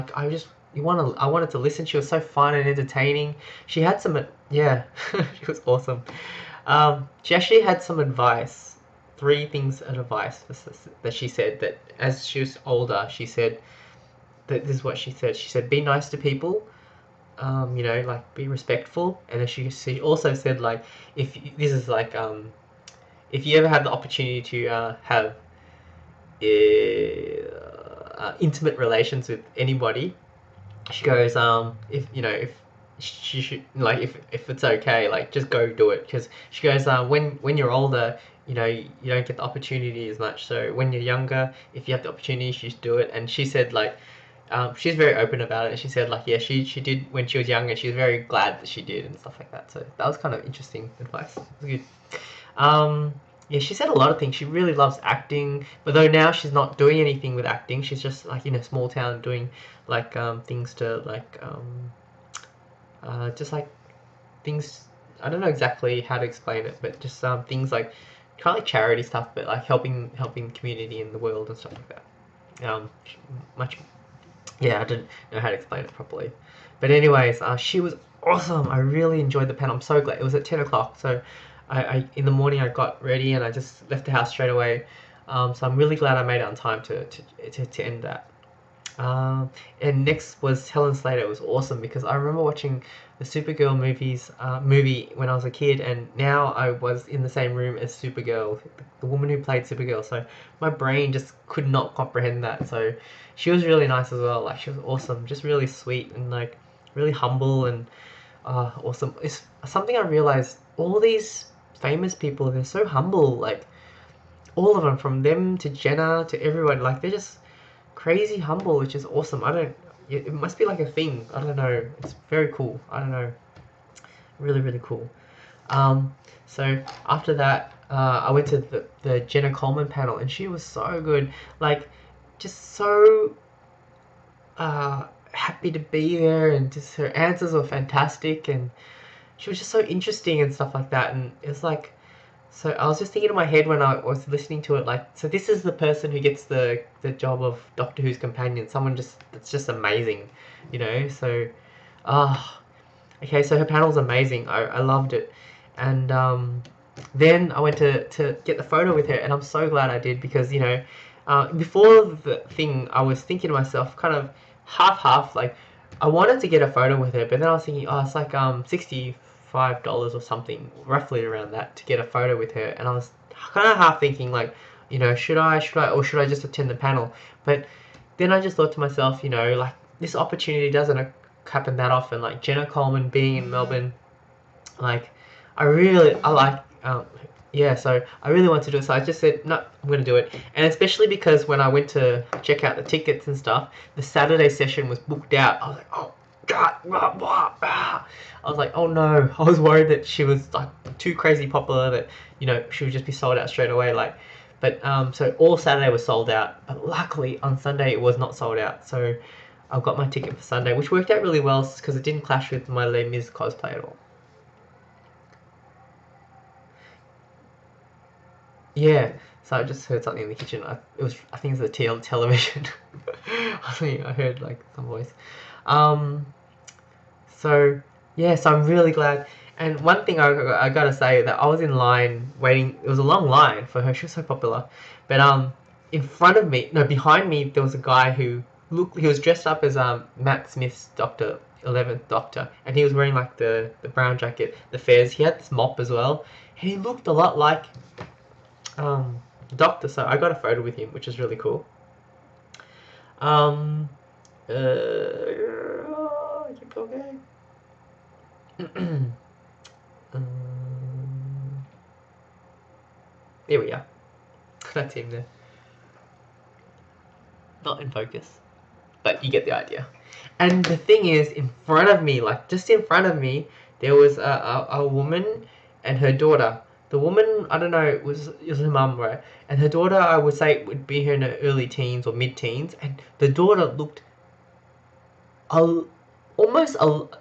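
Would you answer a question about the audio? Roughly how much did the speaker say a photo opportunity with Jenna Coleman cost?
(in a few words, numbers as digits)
$65.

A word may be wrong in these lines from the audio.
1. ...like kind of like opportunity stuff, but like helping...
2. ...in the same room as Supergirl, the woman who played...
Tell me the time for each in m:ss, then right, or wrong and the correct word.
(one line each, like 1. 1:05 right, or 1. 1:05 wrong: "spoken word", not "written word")
1. 1:07 wrong: "charity", not "opportunity"
2. 1:37 right.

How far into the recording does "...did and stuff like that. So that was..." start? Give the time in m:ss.
0:48.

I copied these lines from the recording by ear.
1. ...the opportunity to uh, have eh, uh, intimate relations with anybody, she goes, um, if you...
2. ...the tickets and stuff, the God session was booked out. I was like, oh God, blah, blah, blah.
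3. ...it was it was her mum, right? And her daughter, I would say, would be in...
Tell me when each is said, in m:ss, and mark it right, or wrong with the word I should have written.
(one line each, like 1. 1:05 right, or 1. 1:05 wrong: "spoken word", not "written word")
1. 0:23 right
2. 3:12 wrong: "Saturday", not "God"
3. 4:37 right.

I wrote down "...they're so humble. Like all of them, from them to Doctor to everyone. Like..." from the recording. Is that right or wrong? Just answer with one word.
wrong.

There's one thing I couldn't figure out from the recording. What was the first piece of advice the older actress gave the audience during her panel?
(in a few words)
Be nice to people.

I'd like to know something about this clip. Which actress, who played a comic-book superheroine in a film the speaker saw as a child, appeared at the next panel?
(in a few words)
Helen Slater.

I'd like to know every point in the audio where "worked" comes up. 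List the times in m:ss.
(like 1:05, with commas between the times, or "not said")
3:30.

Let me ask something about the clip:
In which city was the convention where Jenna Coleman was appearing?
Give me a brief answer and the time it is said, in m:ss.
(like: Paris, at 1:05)
Melbourne, at 3:03.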